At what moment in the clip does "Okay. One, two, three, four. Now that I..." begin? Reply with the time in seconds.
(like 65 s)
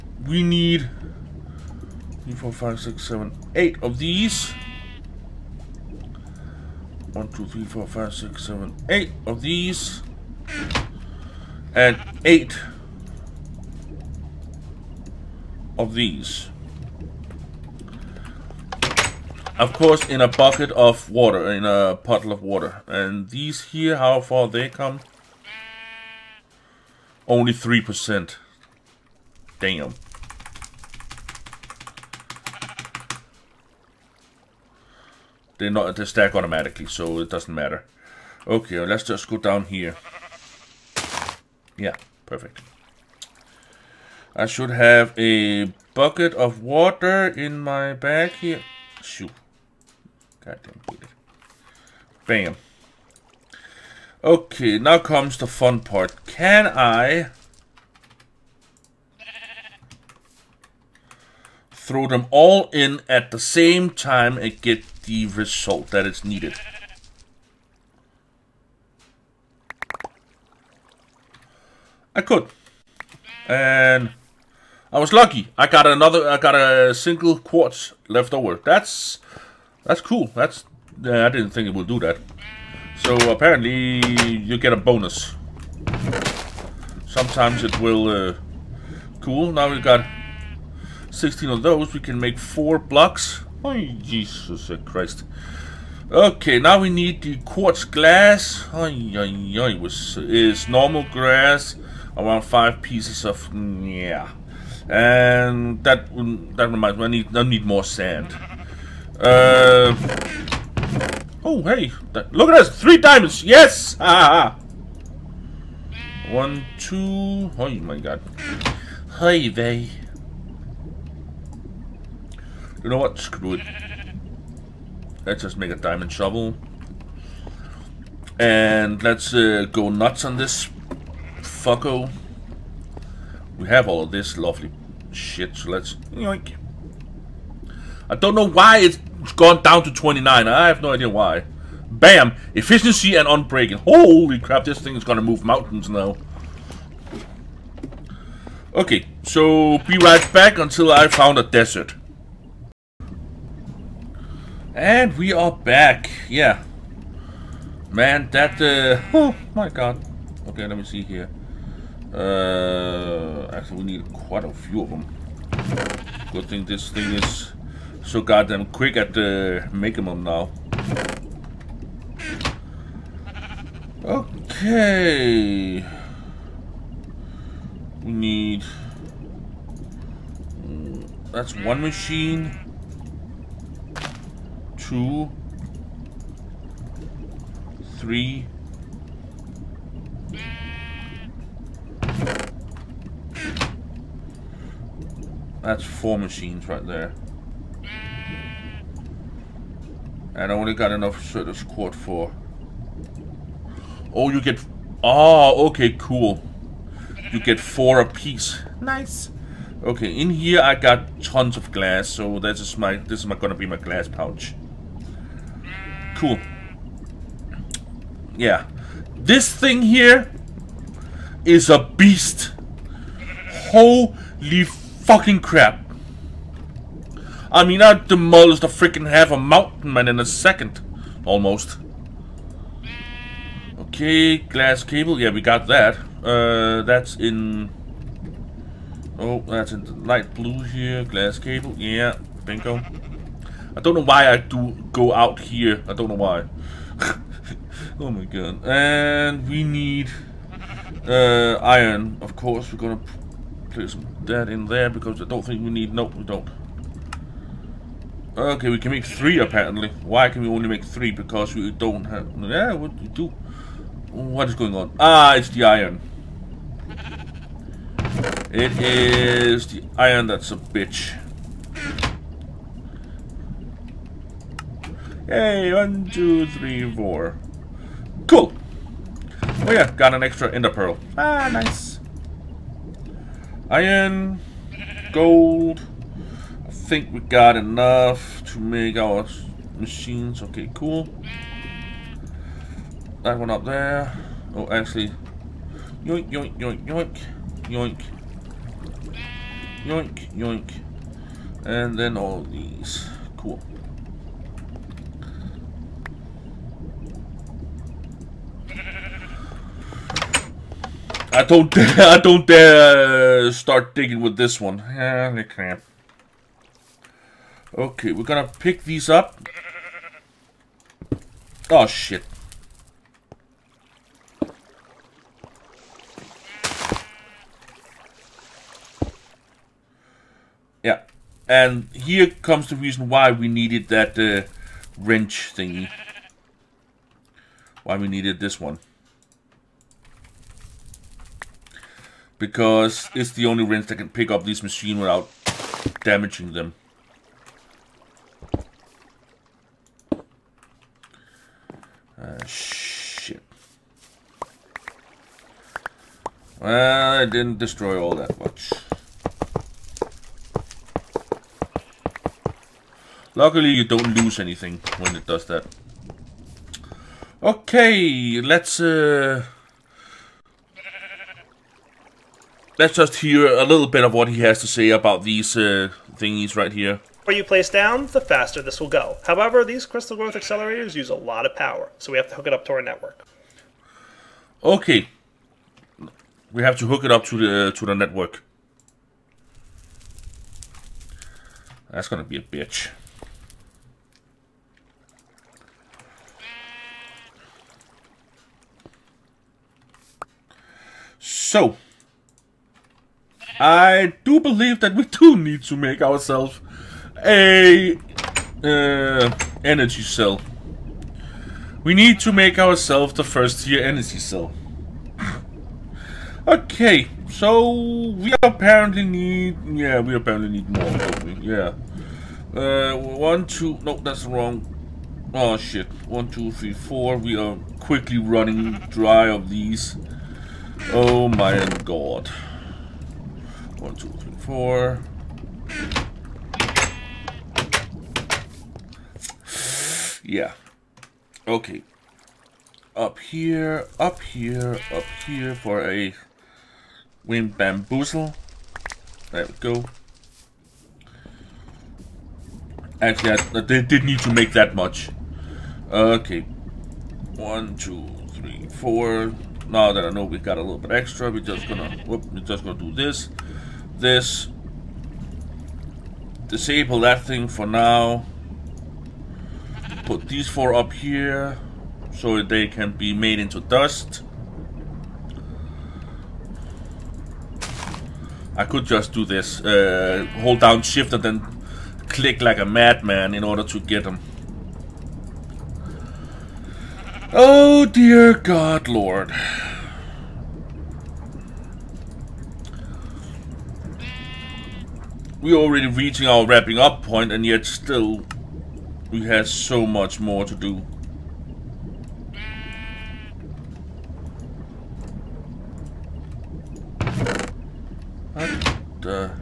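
455 s.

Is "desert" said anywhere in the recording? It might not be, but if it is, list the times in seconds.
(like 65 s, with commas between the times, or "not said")
151 s.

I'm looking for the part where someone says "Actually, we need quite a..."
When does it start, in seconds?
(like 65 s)
163 s.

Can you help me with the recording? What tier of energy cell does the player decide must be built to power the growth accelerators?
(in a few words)
first tier.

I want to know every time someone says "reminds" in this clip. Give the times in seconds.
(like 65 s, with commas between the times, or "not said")
106 s.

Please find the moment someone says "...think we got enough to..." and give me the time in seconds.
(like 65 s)
286 s.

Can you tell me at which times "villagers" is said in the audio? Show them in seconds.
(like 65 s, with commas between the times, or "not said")
not said.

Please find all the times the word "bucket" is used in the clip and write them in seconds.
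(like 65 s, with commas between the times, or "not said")
20 s, 45 s.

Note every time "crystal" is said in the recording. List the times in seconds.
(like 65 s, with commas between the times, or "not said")
379 s.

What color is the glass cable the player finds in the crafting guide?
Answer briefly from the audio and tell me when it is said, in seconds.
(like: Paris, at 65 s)
light blue, at 240 s.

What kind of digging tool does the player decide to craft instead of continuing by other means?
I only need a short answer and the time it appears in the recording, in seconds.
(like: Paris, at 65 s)
diamond shovel, at 125 s.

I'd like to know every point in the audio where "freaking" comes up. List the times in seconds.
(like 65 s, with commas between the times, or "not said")
228 s.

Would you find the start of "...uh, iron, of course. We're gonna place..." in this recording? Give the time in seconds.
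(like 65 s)
251 s.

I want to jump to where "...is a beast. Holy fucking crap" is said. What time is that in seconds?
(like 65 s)
221 s.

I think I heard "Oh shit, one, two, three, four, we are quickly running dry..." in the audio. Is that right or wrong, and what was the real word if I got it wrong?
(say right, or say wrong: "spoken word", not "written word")
right.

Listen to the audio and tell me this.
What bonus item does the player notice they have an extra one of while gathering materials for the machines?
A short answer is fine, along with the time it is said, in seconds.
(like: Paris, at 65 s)
ender pearl, at 280 s.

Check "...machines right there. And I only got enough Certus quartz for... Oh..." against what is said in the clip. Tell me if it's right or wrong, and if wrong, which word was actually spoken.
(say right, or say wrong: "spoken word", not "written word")
right.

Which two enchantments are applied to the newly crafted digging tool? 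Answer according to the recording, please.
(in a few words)
Efficiency and unbreaking.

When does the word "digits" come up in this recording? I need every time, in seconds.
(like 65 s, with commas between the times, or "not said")
not said.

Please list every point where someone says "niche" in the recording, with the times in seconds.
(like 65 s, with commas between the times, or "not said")
not said.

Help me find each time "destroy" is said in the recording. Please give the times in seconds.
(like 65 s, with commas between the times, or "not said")
357 s.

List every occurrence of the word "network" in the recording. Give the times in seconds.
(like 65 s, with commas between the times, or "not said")
382 s, 387 s.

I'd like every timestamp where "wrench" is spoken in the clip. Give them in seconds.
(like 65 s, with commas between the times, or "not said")
334 s, 343 s.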